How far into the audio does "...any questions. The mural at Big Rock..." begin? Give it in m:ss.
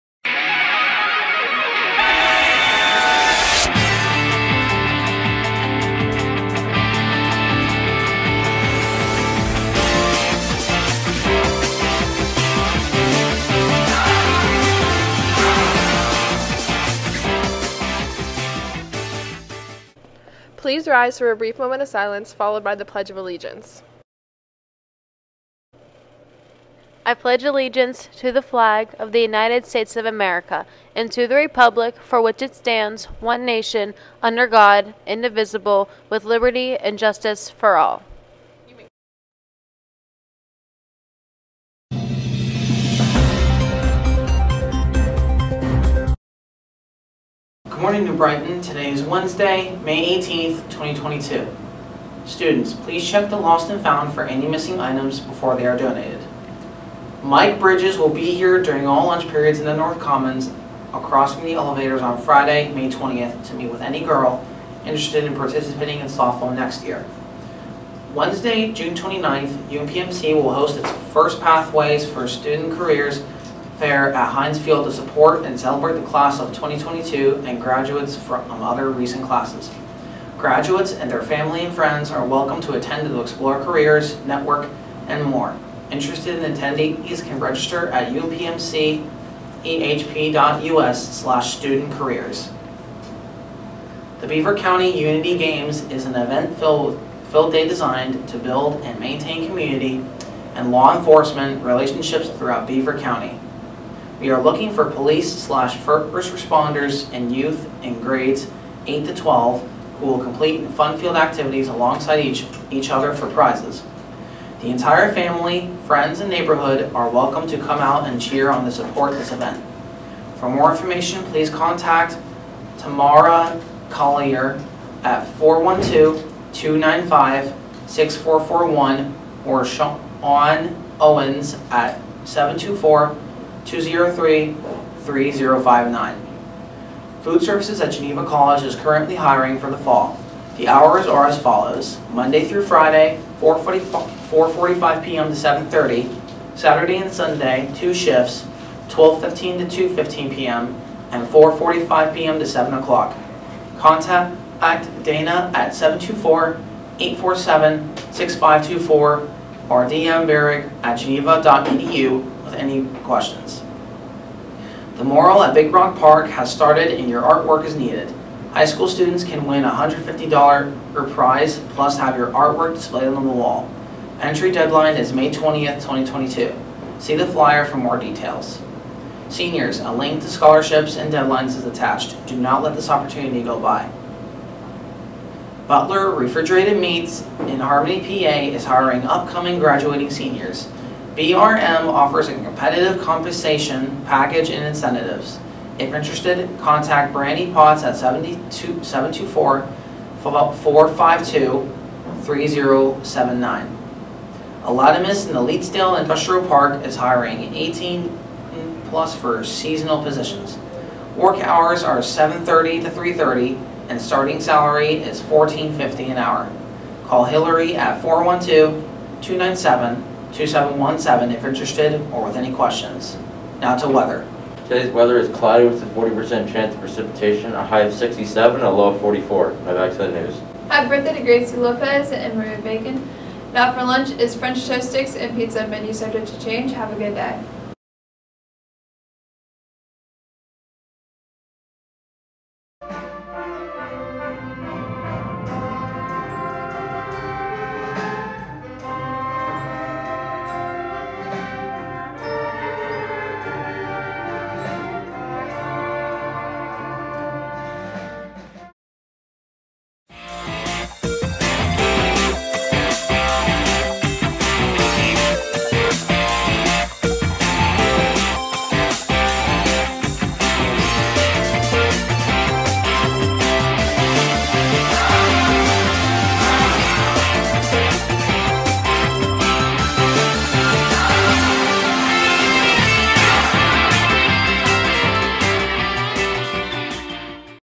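2:42.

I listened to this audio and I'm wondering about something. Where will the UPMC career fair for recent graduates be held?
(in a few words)
Heinz Field.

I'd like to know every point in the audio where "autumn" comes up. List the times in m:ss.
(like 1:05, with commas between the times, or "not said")
not said.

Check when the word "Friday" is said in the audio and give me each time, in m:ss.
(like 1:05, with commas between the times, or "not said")
1:02, 2:22.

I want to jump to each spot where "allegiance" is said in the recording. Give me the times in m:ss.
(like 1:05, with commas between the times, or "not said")
0:23, 0:27.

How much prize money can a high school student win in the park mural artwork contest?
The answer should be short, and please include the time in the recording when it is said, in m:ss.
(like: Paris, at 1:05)
$150, at 2:49.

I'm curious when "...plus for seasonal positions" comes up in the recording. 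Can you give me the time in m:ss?
3:28.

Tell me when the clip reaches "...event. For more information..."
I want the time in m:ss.
1:59.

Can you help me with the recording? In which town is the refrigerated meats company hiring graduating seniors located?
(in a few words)
Harmony, PA.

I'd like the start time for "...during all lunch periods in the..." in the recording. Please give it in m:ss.
0:58.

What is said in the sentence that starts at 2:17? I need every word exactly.
Food Services at Geneva College is currently hiring for the fall.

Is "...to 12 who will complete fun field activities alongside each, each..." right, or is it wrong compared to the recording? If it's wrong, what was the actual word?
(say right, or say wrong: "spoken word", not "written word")
right.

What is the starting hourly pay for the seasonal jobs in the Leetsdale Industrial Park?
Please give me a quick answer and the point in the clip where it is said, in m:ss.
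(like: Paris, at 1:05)
$14.50, at 3:35.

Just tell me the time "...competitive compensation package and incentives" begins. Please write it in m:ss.
3:12.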